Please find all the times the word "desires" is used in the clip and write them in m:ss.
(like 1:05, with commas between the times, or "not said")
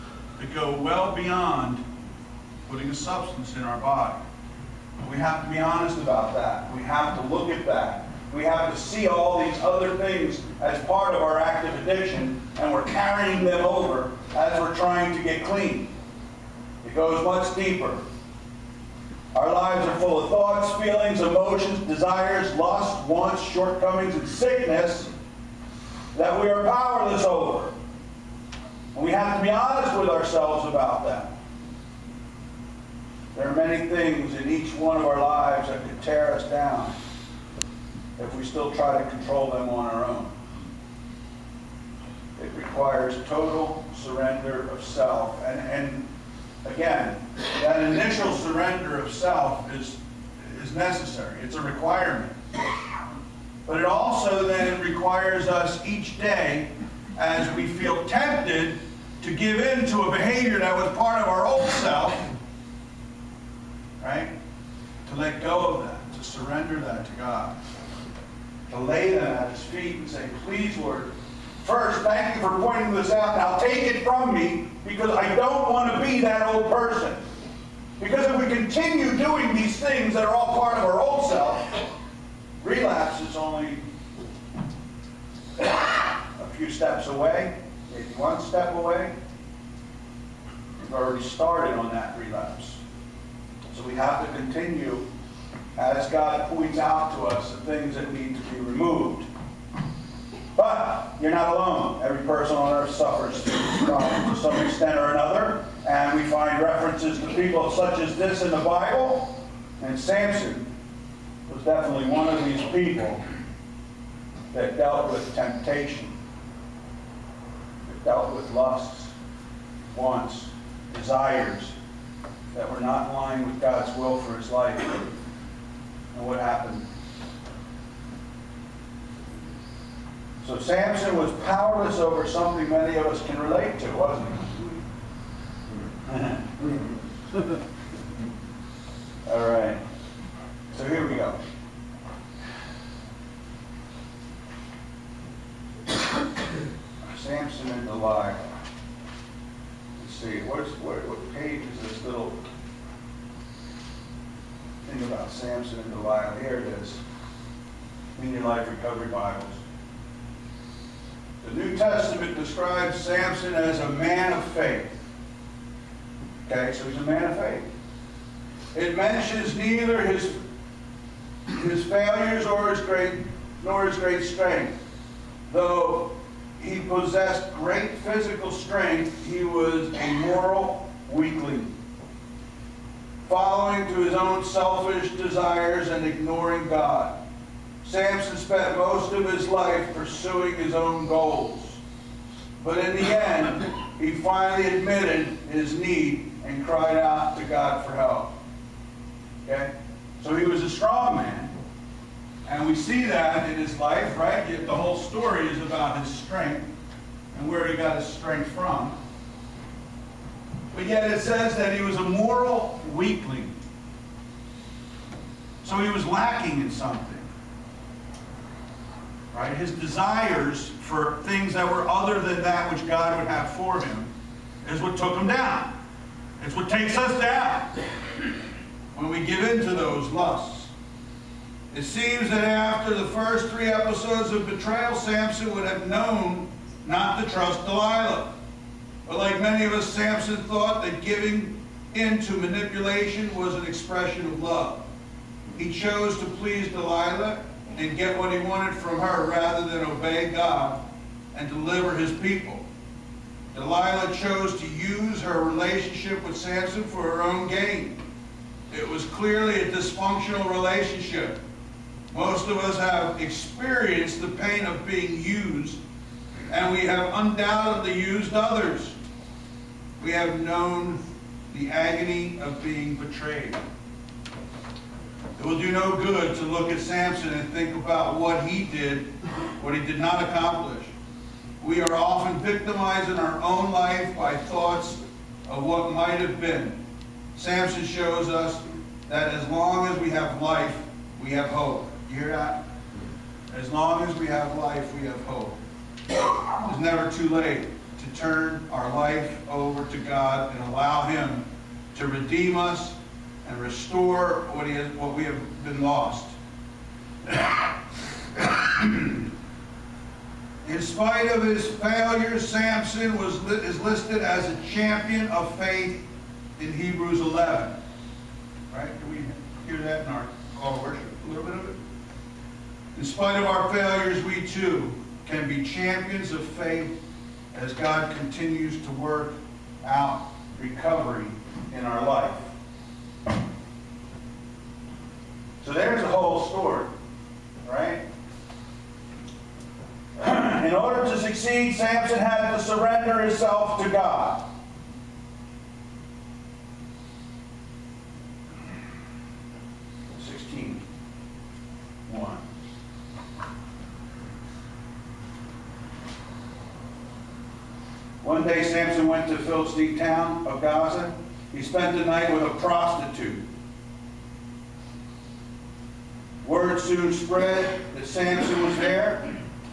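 0:21, 2:00, 3:05, 3:39.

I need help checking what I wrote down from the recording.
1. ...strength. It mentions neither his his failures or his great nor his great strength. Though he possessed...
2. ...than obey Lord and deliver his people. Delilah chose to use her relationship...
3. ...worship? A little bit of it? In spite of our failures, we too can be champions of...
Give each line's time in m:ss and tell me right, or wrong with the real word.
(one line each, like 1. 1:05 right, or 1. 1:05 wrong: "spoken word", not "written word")
1. 2:47 wrong: "faith", not "strength"
2. 4:09 wrong: "God", not "Lord"
3. 5:20 right.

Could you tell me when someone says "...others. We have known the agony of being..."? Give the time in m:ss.
4:28.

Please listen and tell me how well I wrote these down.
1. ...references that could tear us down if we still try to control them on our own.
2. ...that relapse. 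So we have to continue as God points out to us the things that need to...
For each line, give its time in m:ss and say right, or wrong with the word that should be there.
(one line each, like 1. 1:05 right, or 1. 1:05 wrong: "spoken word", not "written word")
1. 0:35 wrong: "lives", not "references"
2. 1:31 right.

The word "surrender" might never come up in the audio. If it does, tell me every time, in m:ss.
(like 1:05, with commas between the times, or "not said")
0:43, 0:48, 1:06, 5:42.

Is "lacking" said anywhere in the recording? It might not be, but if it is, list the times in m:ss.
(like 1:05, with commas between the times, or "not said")
3:36.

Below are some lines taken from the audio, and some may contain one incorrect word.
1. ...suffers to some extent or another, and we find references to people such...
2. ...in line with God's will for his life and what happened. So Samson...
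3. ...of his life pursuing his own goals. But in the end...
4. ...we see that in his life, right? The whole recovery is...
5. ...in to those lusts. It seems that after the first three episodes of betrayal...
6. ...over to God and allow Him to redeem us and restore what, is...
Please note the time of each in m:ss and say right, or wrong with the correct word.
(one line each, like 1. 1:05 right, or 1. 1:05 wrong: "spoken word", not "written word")
1. 1:42 right
2. 2:03 right
3. 3:09 right
4. 3:22 wrong: "story", not "recovery"
5. 3:49 right
6. 4:59 right.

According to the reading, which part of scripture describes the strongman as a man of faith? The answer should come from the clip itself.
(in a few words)
The New Testament.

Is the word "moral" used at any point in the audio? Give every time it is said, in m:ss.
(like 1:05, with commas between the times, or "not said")
3:00, 3:32.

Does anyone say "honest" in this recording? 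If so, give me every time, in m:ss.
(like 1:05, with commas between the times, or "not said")
0:05, 0:29.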